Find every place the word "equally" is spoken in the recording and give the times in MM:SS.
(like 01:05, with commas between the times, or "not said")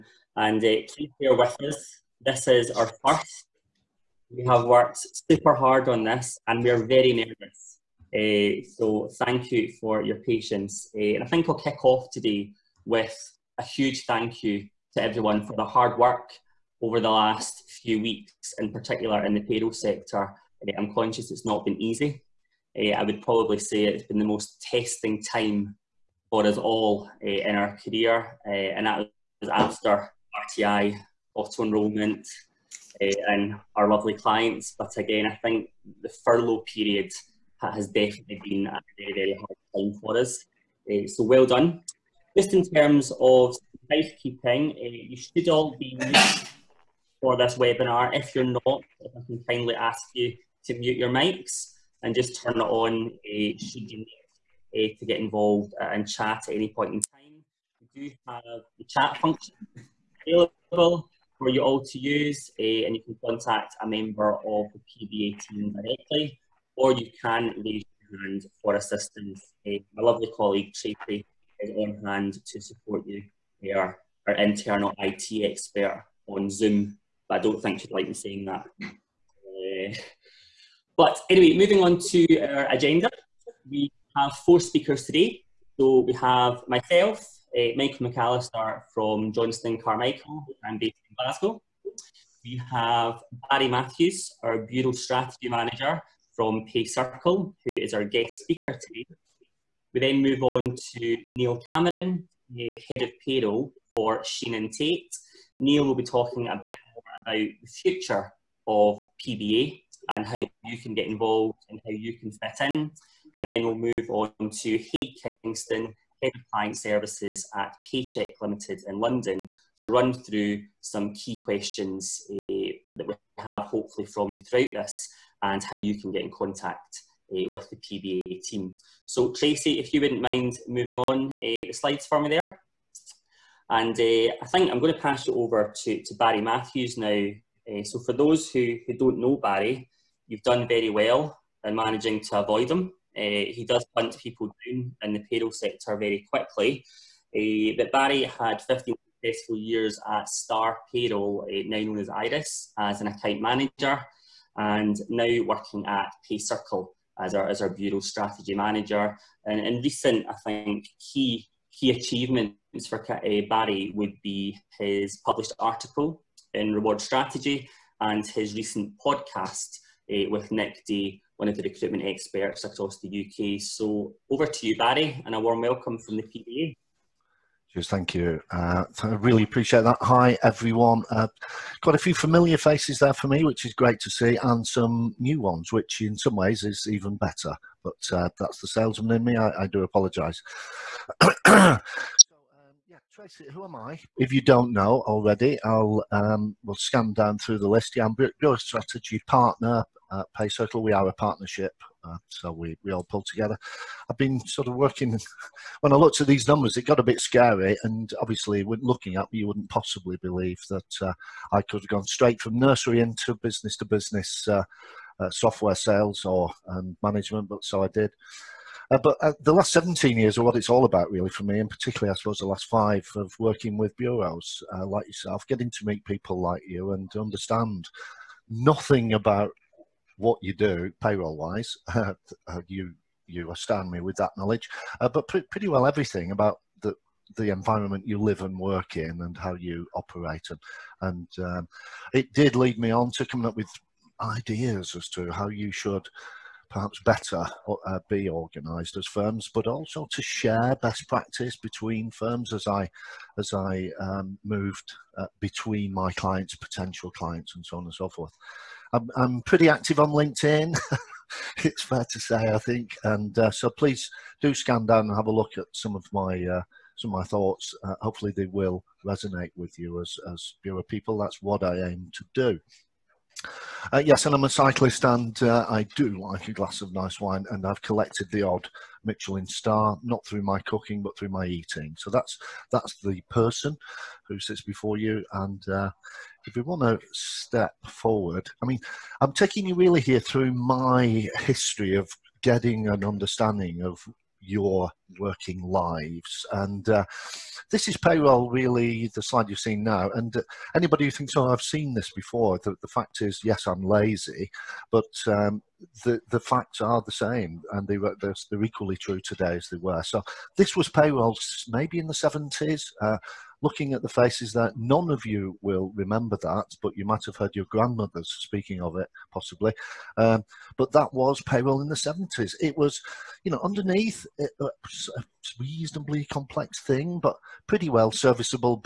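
05:08.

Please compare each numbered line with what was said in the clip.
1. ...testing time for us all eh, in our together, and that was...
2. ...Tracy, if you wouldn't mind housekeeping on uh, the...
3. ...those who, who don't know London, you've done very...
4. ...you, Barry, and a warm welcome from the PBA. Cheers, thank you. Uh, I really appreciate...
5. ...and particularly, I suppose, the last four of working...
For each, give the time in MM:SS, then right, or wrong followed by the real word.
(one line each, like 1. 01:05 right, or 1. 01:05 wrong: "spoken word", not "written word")
1. 00:24 wrong: "career", not "together"
2. 02:09 wrong: "moving", not "housekeeping"
3. 02:18 wrong: "Barry", not "London"
4. 02:54 right
5. 03:41 wrong: "five", not "four".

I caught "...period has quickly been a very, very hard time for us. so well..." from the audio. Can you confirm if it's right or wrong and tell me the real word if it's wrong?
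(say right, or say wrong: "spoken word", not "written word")
wrong: "definitely", not "quickly".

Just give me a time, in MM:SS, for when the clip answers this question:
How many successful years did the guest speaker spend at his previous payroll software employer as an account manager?
02:28.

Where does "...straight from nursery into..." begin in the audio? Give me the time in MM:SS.
03:32.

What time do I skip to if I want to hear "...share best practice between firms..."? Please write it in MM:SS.
04:10.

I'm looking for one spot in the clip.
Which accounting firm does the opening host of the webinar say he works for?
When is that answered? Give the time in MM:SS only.
01:29.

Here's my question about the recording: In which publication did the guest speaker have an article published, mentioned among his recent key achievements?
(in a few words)
Reward Strategy.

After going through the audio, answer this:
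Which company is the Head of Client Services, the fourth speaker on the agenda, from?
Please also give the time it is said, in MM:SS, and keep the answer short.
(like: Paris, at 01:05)
Paycheck Limited, at 01:57.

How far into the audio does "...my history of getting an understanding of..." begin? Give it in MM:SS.
04:50.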